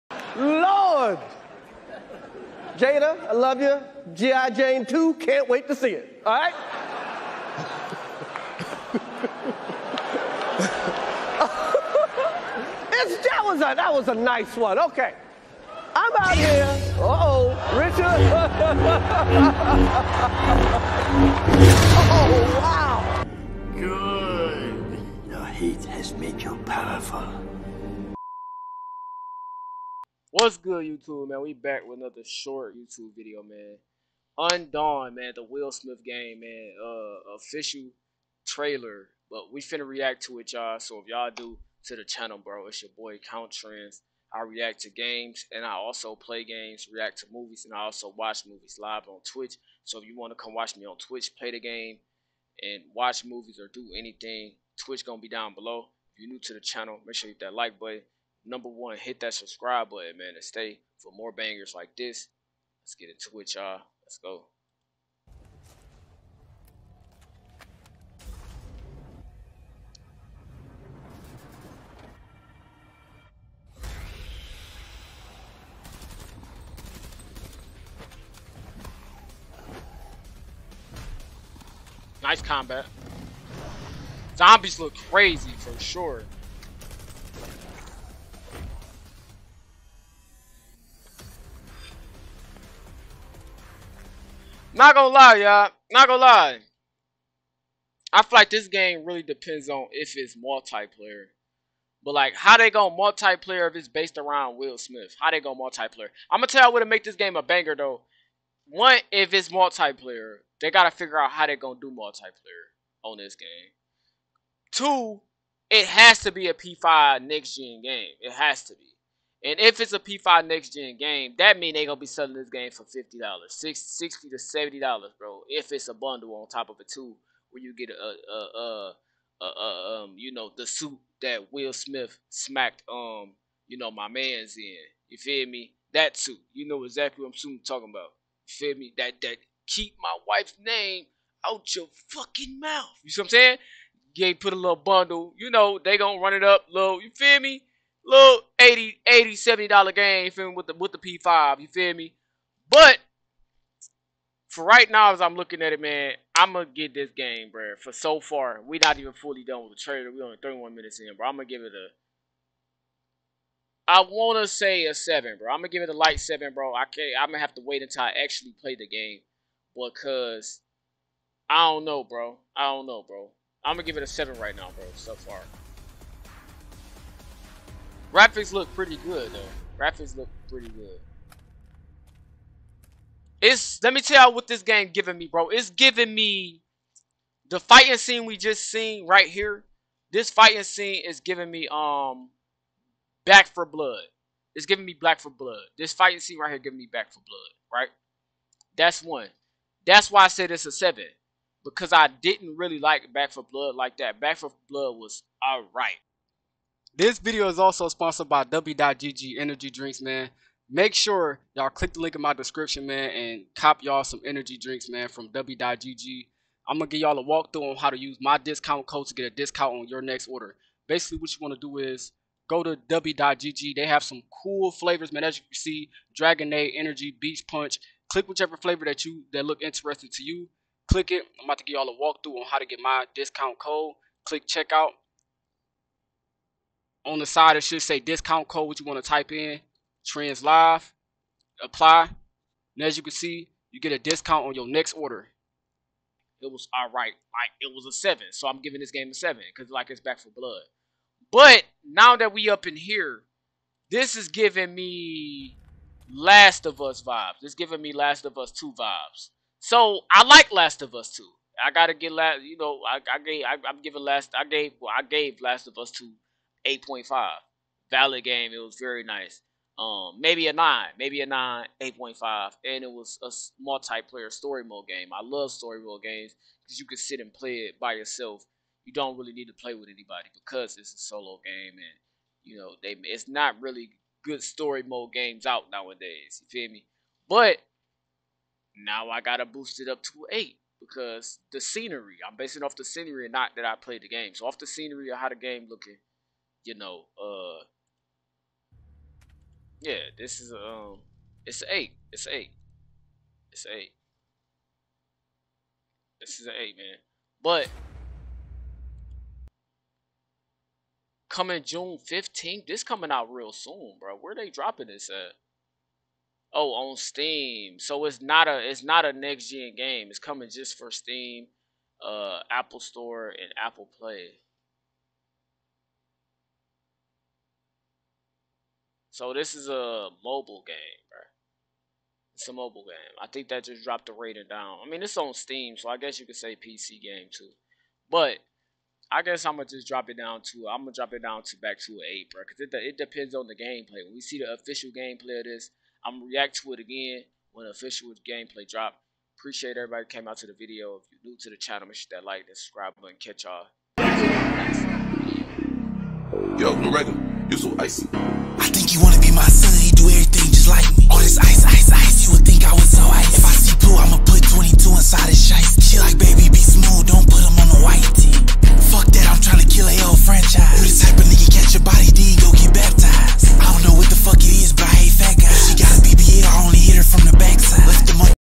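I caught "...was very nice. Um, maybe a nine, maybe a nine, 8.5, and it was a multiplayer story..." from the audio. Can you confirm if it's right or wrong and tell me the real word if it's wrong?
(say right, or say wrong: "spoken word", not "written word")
right.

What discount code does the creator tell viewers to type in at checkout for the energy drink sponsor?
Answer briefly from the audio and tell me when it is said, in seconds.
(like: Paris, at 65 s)
trends live, at 240 s.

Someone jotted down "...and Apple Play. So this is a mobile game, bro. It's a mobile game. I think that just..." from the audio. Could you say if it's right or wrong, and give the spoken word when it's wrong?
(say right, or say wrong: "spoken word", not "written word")
right.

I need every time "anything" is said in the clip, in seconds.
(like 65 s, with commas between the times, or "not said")
53 s.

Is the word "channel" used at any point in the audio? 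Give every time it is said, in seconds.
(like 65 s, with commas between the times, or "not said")
42 s, 56 s, 351 s.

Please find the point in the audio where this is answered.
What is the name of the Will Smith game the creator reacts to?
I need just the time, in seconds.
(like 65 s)
34 s.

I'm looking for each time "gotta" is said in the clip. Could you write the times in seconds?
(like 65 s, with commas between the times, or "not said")
110 s, 261 s, 289 s.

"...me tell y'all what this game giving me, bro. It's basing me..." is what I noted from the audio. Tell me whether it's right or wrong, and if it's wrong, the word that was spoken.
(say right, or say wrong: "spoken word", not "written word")
wrong: "giving", not "basing".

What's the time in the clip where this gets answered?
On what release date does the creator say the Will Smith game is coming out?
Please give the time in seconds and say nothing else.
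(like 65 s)
311 s.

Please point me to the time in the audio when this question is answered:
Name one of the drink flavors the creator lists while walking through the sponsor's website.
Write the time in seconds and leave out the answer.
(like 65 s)
226 s.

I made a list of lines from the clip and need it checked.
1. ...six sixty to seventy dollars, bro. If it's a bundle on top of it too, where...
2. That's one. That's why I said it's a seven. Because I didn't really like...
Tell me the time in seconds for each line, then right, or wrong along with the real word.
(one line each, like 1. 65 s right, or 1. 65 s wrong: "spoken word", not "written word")
1. 123 s right
2. 198 s right.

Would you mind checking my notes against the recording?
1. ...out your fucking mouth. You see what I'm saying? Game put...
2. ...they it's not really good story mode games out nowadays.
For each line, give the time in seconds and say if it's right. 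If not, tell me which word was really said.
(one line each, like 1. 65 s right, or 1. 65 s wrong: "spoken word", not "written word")
1. 141 s right
2. 282 s right.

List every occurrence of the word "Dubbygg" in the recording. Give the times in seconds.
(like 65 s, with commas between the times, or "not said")
208 s, 215 s, 222 s.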